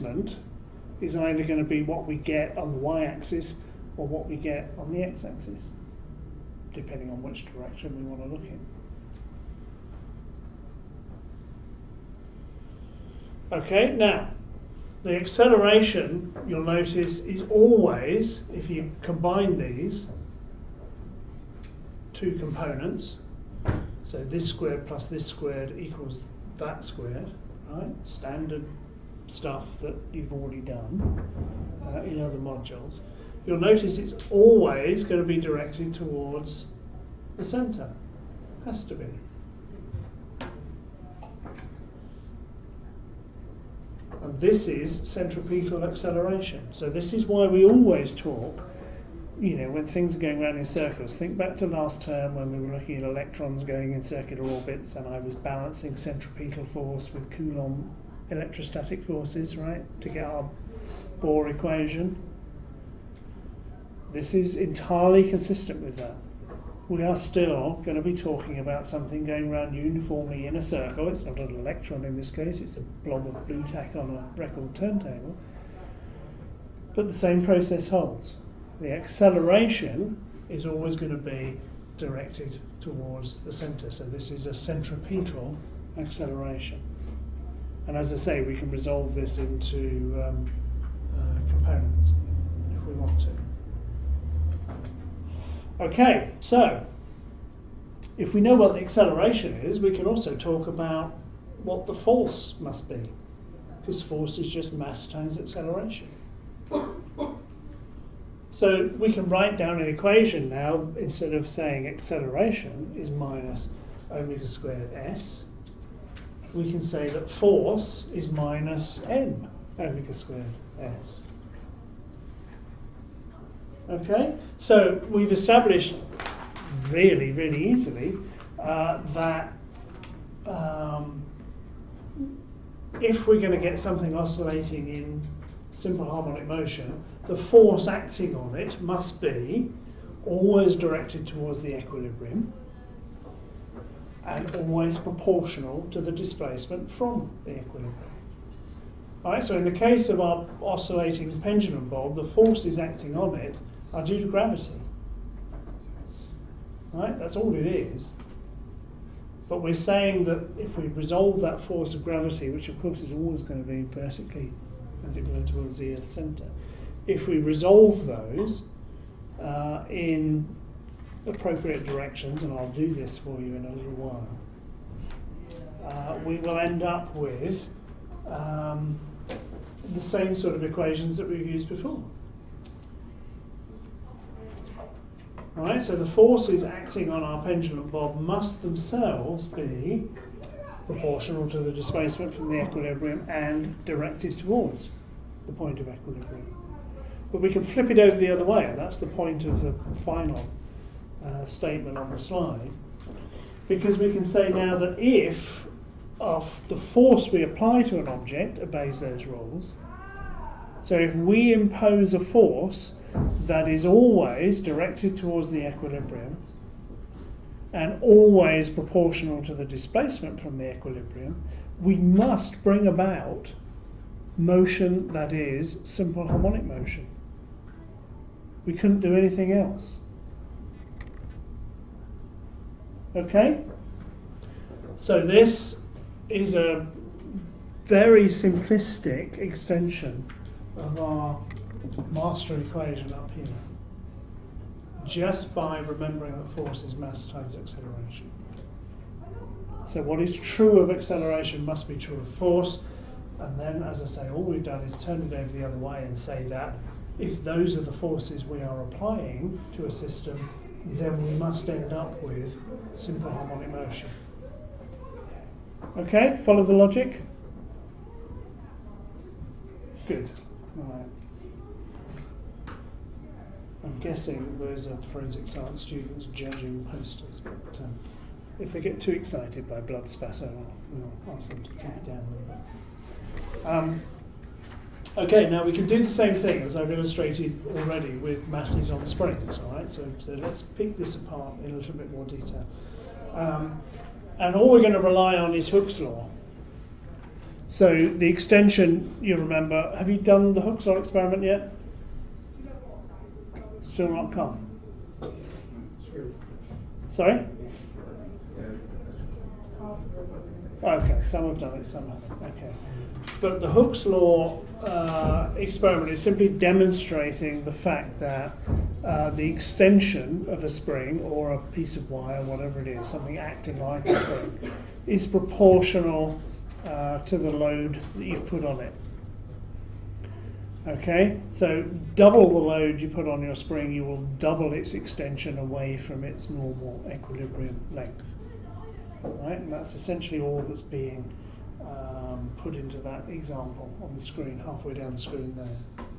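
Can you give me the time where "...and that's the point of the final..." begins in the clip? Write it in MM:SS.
03:18.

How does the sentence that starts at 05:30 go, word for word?
Okay, so double the load you put on your spring, you will double its extension away from its normal equilibrium length.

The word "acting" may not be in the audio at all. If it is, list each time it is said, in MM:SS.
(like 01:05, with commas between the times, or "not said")
02:17, 02:32, 03:06, 05:23.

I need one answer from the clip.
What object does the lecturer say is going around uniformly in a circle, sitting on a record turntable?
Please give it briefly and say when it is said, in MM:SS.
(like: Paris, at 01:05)
Blu-Tack, at 01:12.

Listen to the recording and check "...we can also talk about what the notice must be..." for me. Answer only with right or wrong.
wrong.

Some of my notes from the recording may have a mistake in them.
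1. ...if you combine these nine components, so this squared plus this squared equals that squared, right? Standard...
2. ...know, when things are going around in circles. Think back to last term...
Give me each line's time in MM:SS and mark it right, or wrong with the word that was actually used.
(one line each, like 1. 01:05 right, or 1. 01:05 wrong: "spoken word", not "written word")
1. 00:18 wrong: "two", not "nine"
2. 00:49 right.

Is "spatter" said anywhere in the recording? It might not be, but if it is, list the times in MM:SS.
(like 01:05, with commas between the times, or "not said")
04:40.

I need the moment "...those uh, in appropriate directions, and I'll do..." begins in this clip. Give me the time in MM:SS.
02:48.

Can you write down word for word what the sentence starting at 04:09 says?
So what is true of acceleration must be true of force.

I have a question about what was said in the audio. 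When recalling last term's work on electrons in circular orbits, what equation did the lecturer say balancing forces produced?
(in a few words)
Bohr equation.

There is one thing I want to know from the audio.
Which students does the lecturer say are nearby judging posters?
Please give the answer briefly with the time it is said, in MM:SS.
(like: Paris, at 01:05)
forensic science students, at 04:35.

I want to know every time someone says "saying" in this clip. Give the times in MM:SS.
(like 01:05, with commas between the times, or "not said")
01:51, 02:39.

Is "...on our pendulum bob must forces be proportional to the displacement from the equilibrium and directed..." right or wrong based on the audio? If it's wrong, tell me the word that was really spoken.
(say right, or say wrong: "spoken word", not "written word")
wrong: "themselves", not "forces".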